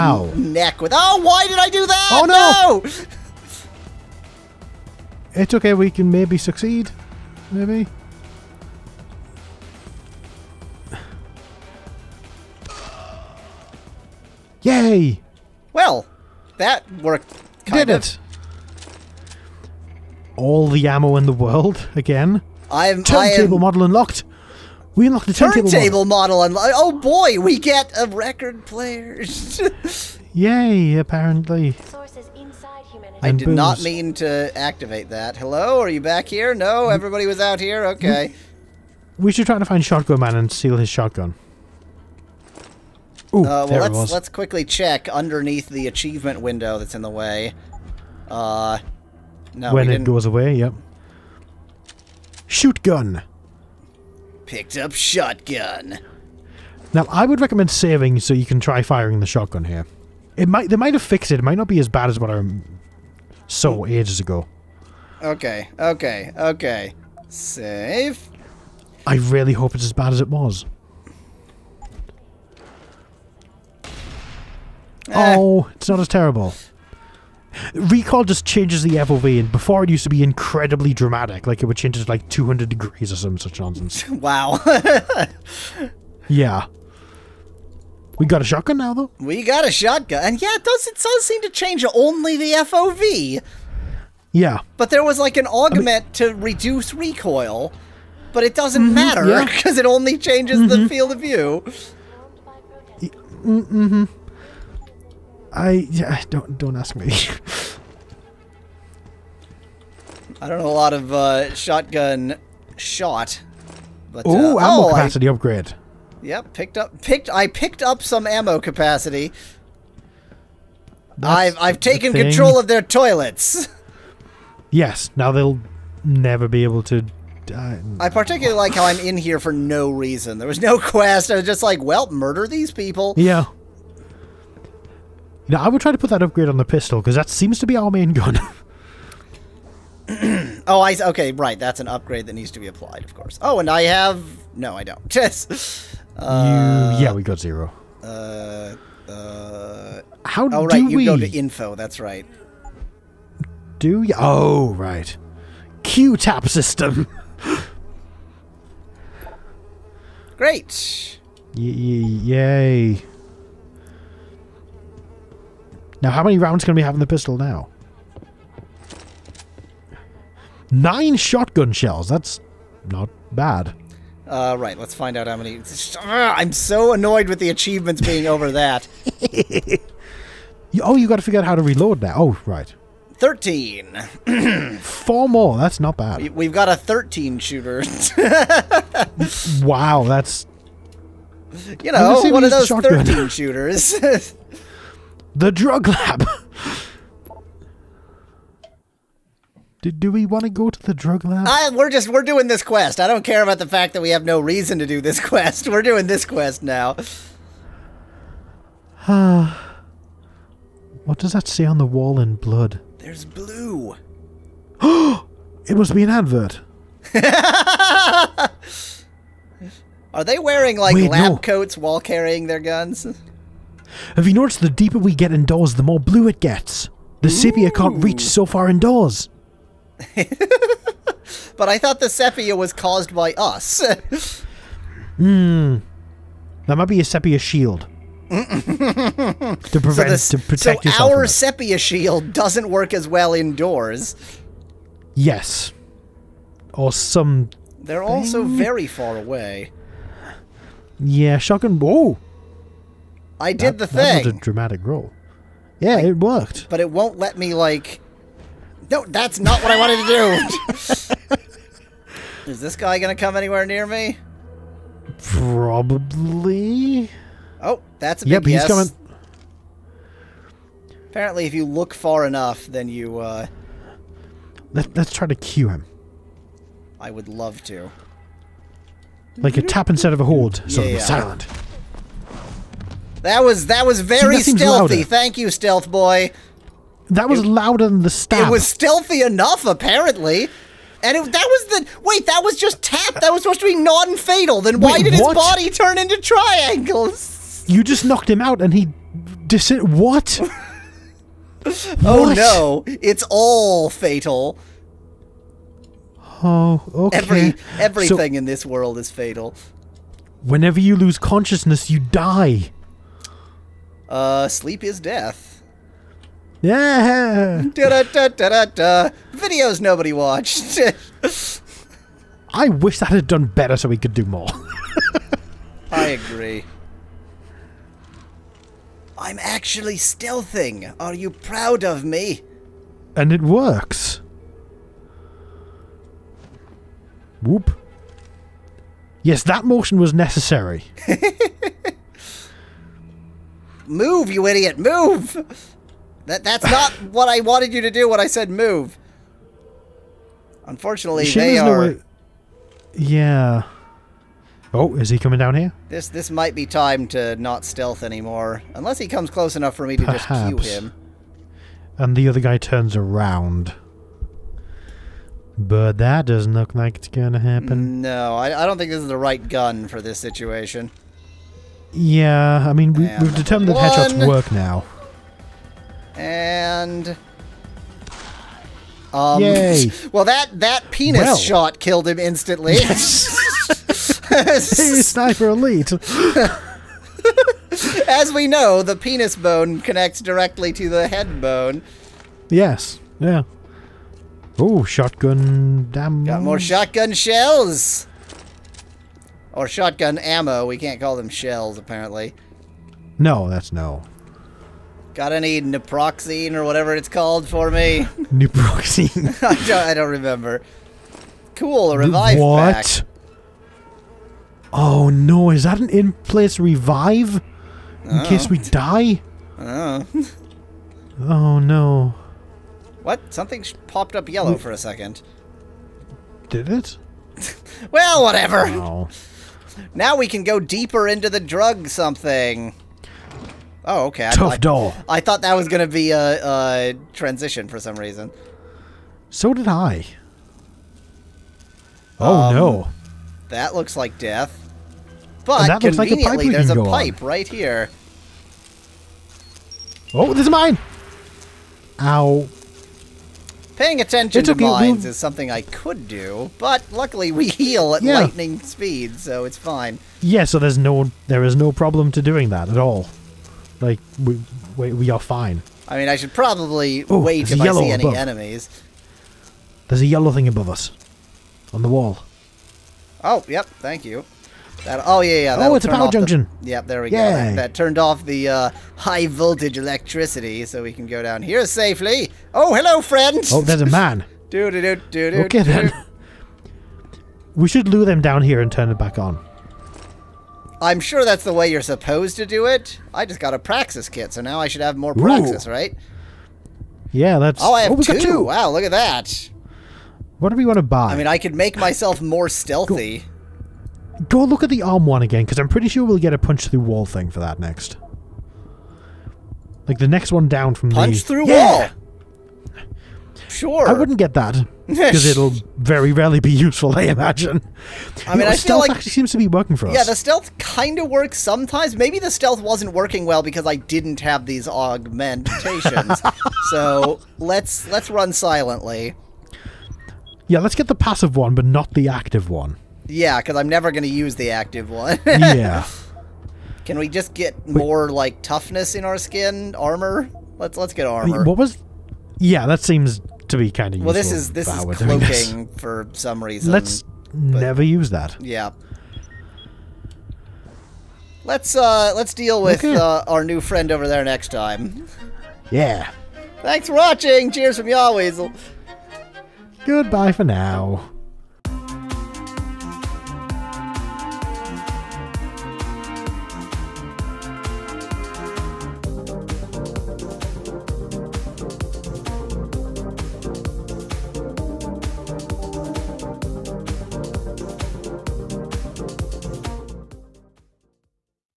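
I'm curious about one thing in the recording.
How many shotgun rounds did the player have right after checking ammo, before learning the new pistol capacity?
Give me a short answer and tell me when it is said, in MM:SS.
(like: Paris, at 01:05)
Nine, at 02:50.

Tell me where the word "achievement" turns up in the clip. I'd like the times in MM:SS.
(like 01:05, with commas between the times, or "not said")
00:45, 02:57.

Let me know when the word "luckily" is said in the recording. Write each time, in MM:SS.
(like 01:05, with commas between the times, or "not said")
07:36.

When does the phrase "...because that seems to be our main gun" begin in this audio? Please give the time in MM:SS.
02:16.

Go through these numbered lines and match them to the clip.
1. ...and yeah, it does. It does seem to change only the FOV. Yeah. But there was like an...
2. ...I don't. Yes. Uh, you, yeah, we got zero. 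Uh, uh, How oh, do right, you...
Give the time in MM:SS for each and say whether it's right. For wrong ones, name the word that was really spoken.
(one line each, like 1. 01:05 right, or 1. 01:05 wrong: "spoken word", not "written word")
1. 01:30 right
2. 02:24 right.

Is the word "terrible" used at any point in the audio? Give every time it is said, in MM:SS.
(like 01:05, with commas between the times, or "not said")
01:16.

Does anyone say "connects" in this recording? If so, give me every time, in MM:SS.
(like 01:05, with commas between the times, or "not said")
06:29.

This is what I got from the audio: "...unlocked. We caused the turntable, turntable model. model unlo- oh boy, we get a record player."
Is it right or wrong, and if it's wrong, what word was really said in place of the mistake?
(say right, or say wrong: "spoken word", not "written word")
wrong: "unlocked", not "caused".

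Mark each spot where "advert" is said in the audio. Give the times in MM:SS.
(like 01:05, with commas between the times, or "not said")
03:36.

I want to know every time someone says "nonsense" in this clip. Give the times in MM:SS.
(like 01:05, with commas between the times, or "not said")
01:23.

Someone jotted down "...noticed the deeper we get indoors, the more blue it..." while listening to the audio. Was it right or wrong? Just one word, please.
right.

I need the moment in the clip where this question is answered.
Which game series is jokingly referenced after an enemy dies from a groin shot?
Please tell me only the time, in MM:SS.
06:24.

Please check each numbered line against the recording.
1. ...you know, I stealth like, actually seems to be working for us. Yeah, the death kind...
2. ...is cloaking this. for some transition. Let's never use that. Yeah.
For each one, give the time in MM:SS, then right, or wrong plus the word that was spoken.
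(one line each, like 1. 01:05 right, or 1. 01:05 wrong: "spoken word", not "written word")
1. 08:38 wrong: "stealth", not "death"
2. 09:04 wrong: "reason", not "transition".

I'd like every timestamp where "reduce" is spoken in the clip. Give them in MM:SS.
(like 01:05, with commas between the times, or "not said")
01:36.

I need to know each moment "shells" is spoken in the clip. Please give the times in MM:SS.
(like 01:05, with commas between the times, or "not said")
02:51, 06:37, 06:41.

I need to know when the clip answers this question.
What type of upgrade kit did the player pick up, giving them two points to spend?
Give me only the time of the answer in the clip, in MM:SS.
08:13.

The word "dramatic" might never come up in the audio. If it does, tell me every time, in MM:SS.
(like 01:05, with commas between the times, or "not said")
01:20, 04:14.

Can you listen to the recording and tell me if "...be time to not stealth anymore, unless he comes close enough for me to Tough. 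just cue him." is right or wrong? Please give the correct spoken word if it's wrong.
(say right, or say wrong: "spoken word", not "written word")
wrong: "Perhaps", not "Tough".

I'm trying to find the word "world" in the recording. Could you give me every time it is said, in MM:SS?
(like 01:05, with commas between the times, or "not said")
00:21, 05:08.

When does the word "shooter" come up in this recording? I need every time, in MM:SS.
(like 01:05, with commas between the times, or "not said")
03:07, 03:13.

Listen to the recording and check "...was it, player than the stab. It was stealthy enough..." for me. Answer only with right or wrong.
wrong.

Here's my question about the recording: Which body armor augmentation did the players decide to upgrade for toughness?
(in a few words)
Skin armor.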